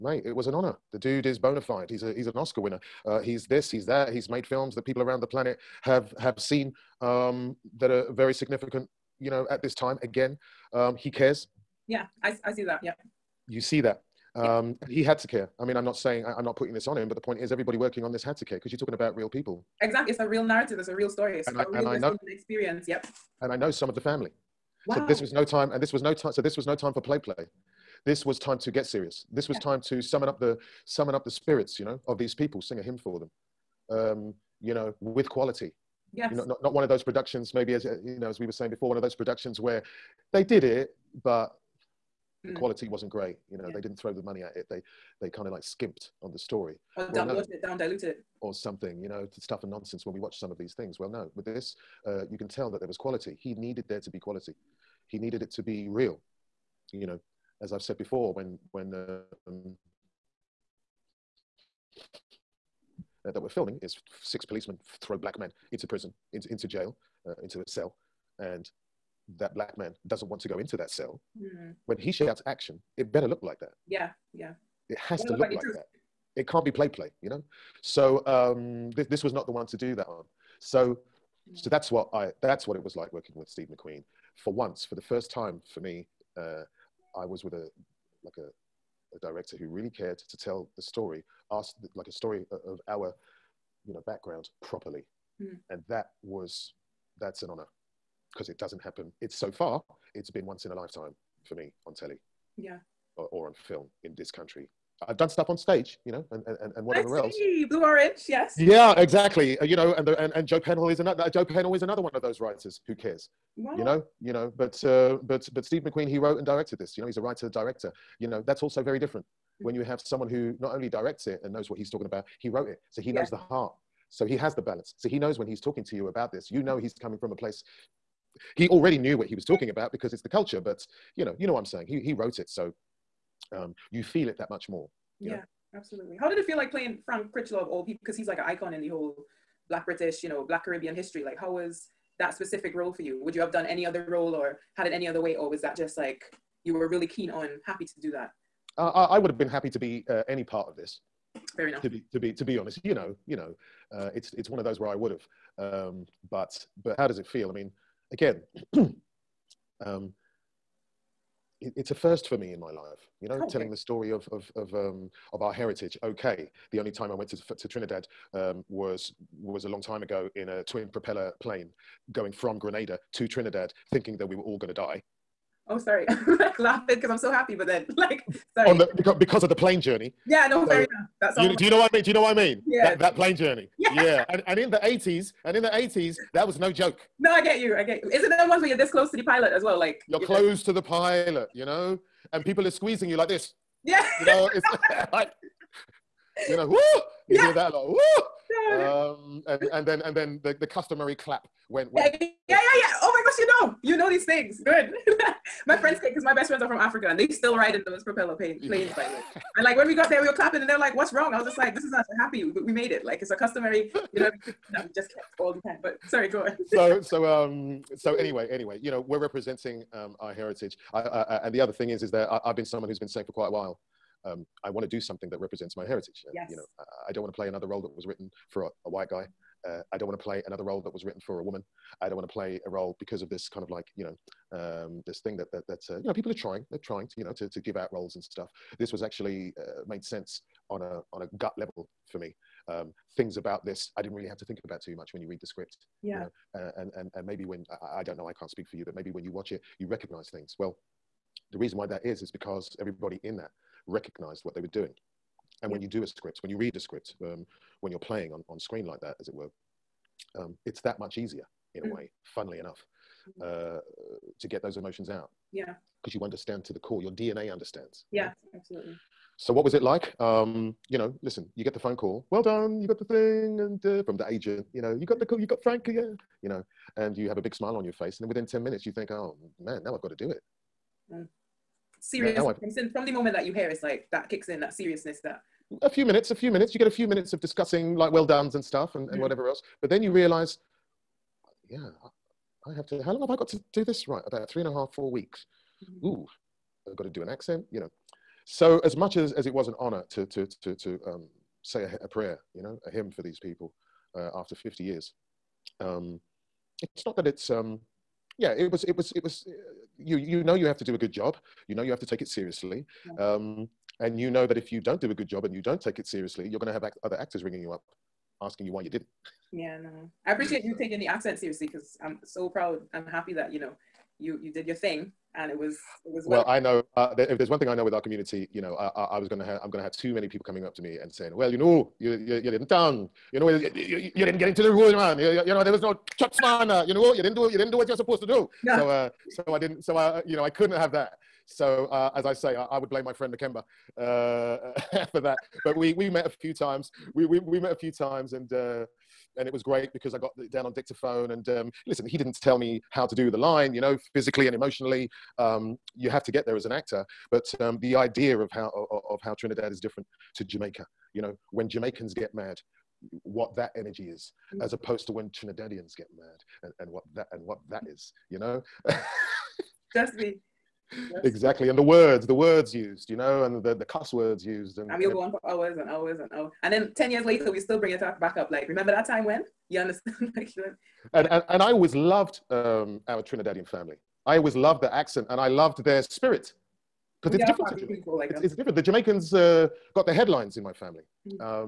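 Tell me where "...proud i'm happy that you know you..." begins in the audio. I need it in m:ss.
5:22.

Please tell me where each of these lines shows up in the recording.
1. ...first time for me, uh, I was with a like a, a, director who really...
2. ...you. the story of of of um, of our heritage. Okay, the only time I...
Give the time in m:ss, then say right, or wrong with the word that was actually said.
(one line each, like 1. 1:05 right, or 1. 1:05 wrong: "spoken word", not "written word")
1. 1:25 right
2. 2:43 right.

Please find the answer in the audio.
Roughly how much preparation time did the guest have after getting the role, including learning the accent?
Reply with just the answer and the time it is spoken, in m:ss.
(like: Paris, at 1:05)
3 and a half to 4 weeks, at 4:54.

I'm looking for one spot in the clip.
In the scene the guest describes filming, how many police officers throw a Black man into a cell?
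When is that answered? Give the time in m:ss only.
1:04.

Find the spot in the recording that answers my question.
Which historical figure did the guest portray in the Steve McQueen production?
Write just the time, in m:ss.
2:17.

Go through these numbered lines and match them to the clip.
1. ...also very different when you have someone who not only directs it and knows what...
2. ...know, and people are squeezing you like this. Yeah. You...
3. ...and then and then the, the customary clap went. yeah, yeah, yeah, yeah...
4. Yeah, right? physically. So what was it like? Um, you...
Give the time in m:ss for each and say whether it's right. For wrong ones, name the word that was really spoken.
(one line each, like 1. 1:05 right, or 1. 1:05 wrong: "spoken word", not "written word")
1. 1:58 right
2. 3:11 right
3. 3:19 right
4. 4:28 wrong: "absolutely", not "physically".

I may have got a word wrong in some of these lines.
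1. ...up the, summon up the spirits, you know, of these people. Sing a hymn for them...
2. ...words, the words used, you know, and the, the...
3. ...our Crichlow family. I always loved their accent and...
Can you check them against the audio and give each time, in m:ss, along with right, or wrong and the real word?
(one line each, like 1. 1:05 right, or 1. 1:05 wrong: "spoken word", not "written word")
1. 0:30 right
2. 6:11 right
3. 6:23 wrong: "Trinidadian", not "Crichlow".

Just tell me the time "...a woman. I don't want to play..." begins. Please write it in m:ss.
3:51.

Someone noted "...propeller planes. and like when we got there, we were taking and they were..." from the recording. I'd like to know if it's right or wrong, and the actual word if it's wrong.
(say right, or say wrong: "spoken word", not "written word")
wrong: "clapping", not "taking".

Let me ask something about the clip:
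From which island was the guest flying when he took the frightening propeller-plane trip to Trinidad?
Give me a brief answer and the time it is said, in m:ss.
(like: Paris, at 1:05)
Grenada, at 2:52.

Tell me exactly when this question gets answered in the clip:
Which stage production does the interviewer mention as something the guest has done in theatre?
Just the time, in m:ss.
1:47.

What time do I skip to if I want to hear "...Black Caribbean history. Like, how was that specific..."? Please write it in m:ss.
2:20.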